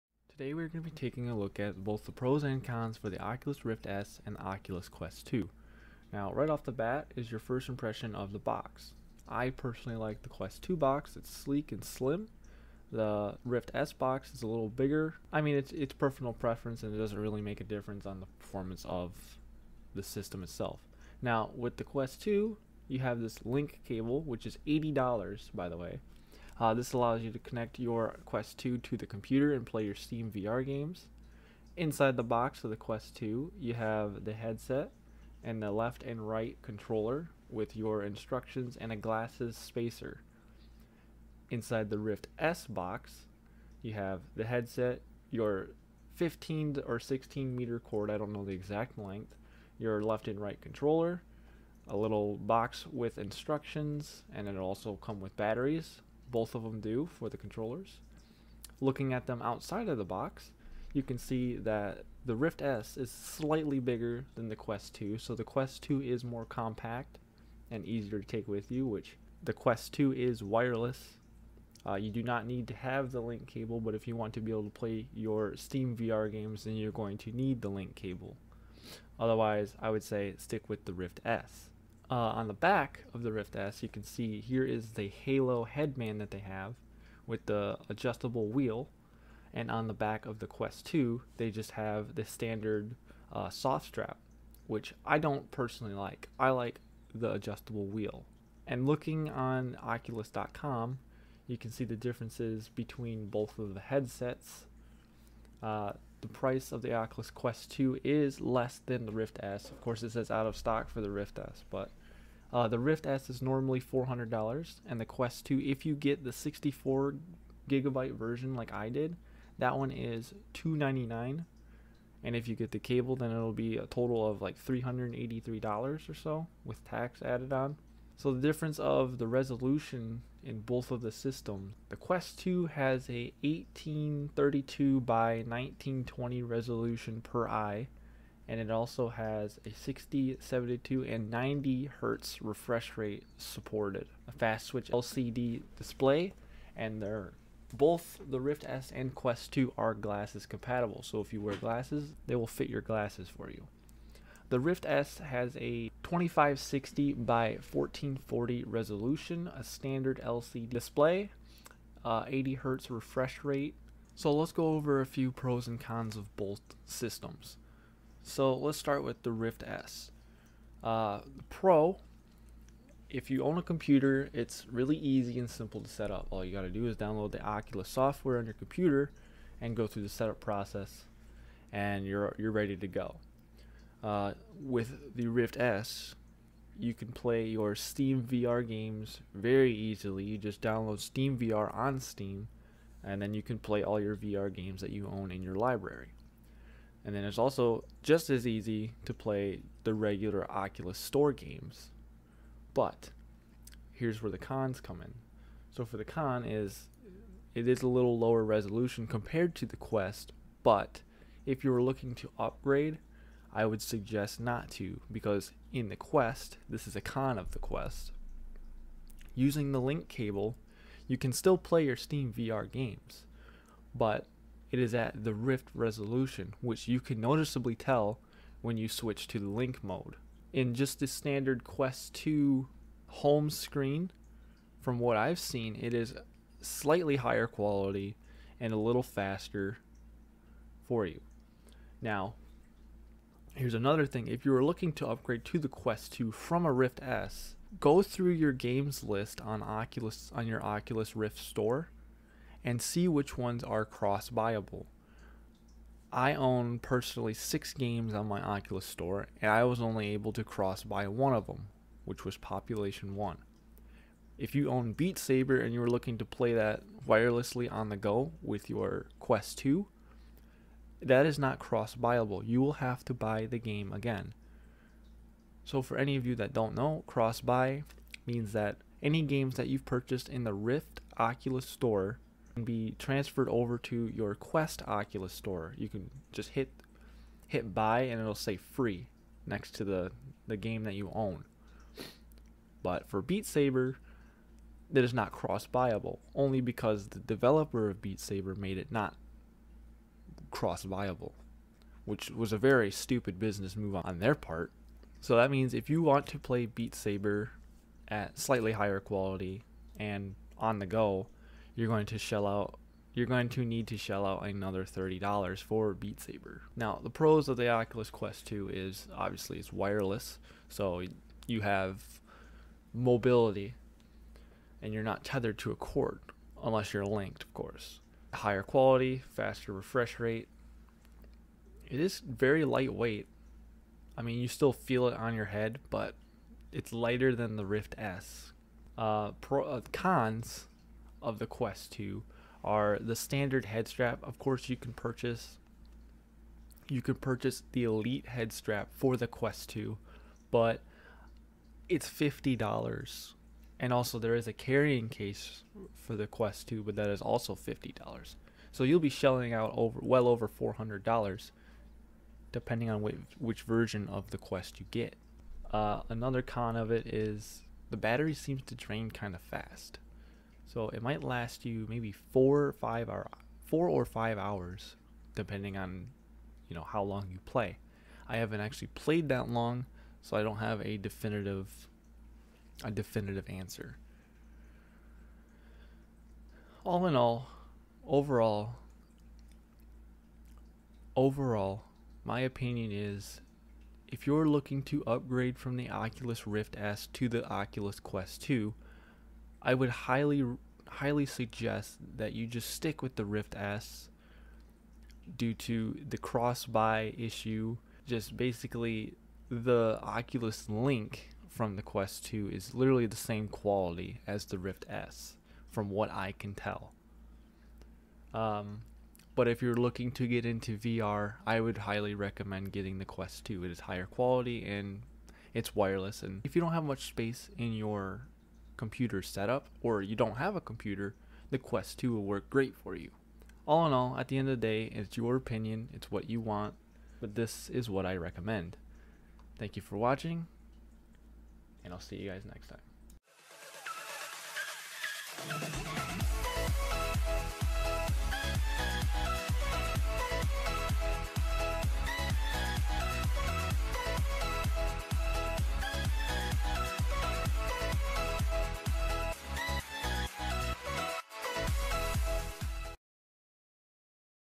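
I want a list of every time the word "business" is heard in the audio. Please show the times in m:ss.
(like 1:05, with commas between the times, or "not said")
5:03.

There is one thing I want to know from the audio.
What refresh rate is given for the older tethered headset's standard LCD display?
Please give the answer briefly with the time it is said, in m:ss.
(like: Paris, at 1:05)
80 hertz, at 2:42.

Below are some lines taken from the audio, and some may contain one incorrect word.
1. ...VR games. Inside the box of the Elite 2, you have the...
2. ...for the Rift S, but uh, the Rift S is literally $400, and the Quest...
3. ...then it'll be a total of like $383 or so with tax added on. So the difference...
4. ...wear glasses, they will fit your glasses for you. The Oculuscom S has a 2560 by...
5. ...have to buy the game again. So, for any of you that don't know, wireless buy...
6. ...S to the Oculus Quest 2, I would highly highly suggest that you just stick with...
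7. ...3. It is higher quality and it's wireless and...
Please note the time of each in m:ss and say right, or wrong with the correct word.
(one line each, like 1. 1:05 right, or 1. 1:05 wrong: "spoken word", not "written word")
1. 0:30 wrong: "Quest", not "Elite"
2. 1:50 wrong: "normally", not "literally"
3. 2:03 right
4. 2:31 wrong: "Rift", not "Oculuscom"
5. 4:32 wrong: "cross", not "wireless"
6. 6:36 right
7. 7:03 wrong: "2", not "3".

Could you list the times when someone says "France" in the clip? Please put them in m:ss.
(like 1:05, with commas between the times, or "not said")
not said.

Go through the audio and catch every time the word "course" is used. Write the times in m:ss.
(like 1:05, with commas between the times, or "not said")
1:49, 5:27, 5:44.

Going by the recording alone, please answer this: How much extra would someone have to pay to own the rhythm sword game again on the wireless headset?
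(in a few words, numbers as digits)
$30.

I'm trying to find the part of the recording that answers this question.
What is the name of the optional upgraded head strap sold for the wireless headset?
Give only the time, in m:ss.
5:47.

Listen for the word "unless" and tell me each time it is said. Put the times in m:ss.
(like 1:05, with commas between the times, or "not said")
5:26.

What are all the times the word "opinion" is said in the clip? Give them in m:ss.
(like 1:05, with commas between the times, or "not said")
6:32, 7:15.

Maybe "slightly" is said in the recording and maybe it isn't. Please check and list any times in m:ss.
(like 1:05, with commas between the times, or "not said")
1:03, 3:56, 5:08.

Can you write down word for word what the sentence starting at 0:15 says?
I mean it's, it's personal preference and it doesn't really make a difference on the performance of the system itself.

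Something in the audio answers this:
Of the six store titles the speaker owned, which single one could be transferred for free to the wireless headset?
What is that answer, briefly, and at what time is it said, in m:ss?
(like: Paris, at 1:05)
Population 1, at 4:22.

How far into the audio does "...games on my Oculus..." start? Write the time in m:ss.
4:17.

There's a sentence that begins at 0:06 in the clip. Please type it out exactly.
Now right off the bat is your first impression of the box.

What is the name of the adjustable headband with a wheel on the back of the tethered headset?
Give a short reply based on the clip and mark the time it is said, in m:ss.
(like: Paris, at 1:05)
Halo headband, at 1:25.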